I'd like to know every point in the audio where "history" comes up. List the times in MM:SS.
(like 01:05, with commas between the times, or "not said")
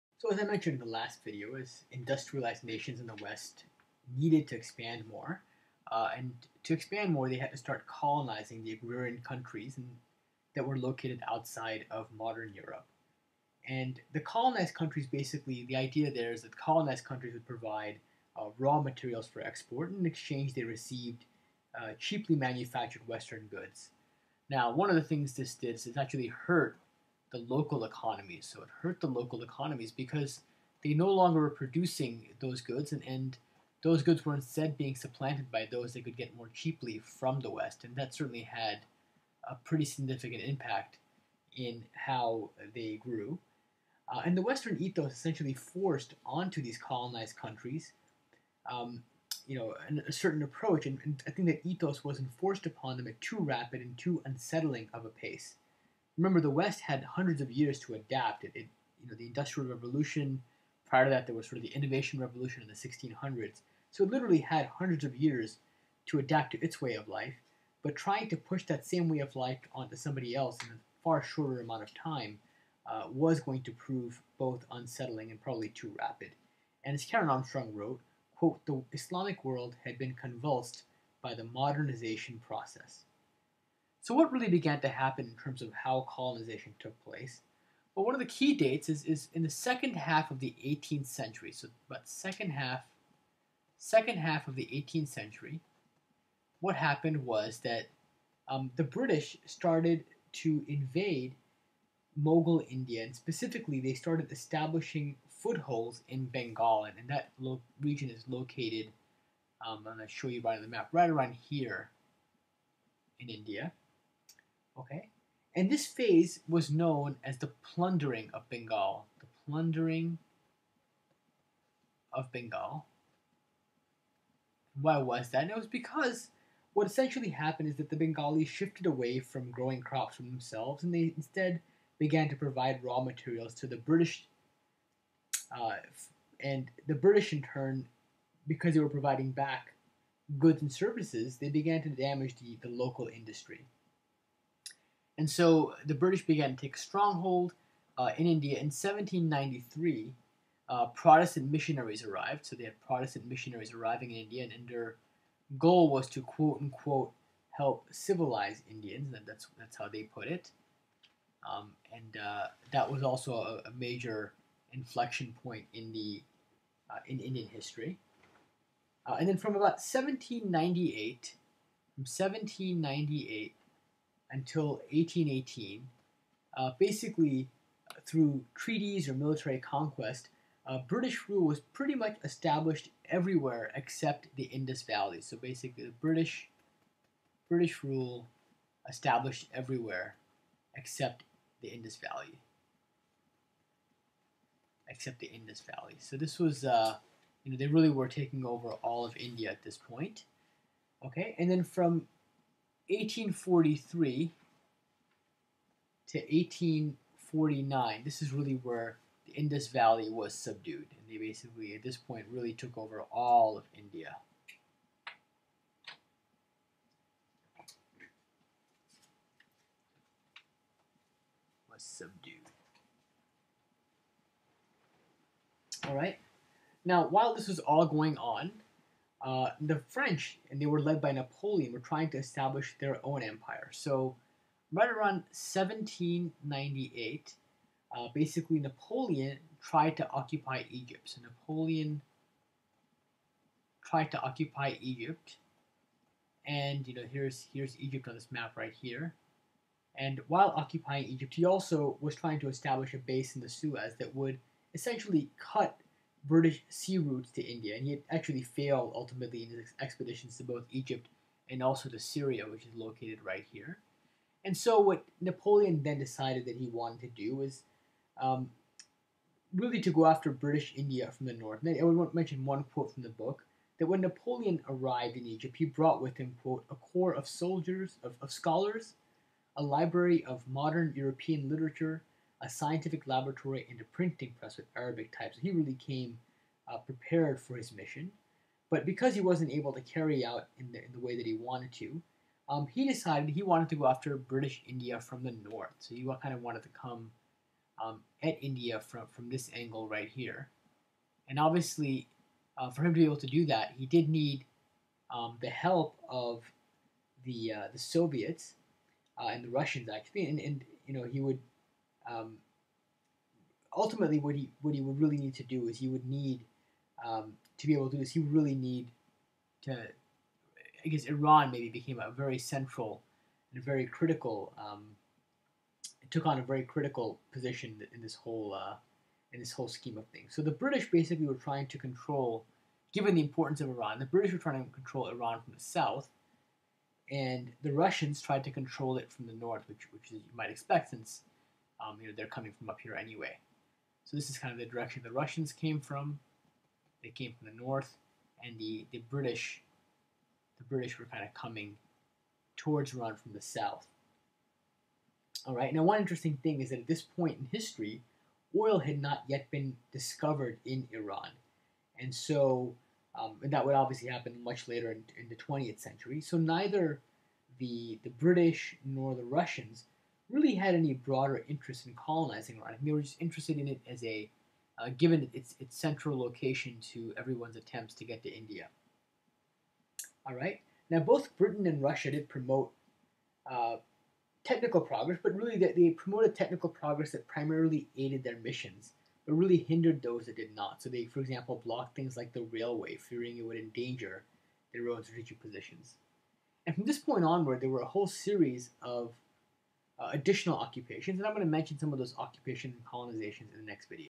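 02:47, 05:57.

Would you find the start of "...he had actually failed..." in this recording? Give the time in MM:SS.
04:17.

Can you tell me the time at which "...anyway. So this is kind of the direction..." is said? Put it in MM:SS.
05:42.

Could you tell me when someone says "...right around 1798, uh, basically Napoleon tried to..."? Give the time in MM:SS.
03:54.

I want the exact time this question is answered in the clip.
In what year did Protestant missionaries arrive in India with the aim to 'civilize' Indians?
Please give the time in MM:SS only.
02:28.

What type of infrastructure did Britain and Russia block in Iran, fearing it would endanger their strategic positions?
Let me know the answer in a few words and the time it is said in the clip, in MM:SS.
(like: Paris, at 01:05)
The railway, at 06:32.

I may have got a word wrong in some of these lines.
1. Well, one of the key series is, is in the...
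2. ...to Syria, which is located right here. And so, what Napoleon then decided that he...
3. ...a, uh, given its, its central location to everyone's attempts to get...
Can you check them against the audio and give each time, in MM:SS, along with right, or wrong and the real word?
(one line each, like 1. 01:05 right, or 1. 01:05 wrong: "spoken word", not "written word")
1. 01:27 wrong: "dates", not "series"
2. 04:21 right
3. 06:14 right.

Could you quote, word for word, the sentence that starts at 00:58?
It, it, you know, the Industrial Revolution.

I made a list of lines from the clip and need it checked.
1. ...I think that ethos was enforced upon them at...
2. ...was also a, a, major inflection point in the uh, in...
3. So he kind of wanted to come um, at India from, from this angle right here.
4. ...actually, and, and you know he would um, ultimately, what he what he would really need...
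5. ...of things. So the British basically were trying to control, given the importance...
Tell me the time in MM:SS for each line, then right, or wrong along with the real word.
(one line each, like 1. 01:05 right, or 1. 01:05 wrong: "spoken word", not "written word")
1. 00:51 right
2. 02:42 right
3. 04:55 right
4. 05:09 right
5. 05:29 right.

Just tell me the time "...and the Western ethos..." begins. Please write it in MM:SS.
00:44.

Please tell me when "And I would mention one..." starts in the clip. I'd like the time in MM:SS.
04:31.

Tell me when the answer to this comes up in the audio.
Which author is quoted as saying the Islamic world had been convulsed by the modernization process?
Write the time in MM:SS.
01:17.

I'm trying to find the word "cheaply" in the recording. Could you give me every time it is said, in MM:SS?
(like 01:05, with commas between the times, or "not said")
00:21, 00:36.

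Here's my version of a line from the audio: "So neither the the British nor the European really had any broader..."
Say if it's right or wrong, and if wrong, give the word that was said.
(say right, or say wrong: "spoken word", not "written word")
wrong: "Russians", not "European".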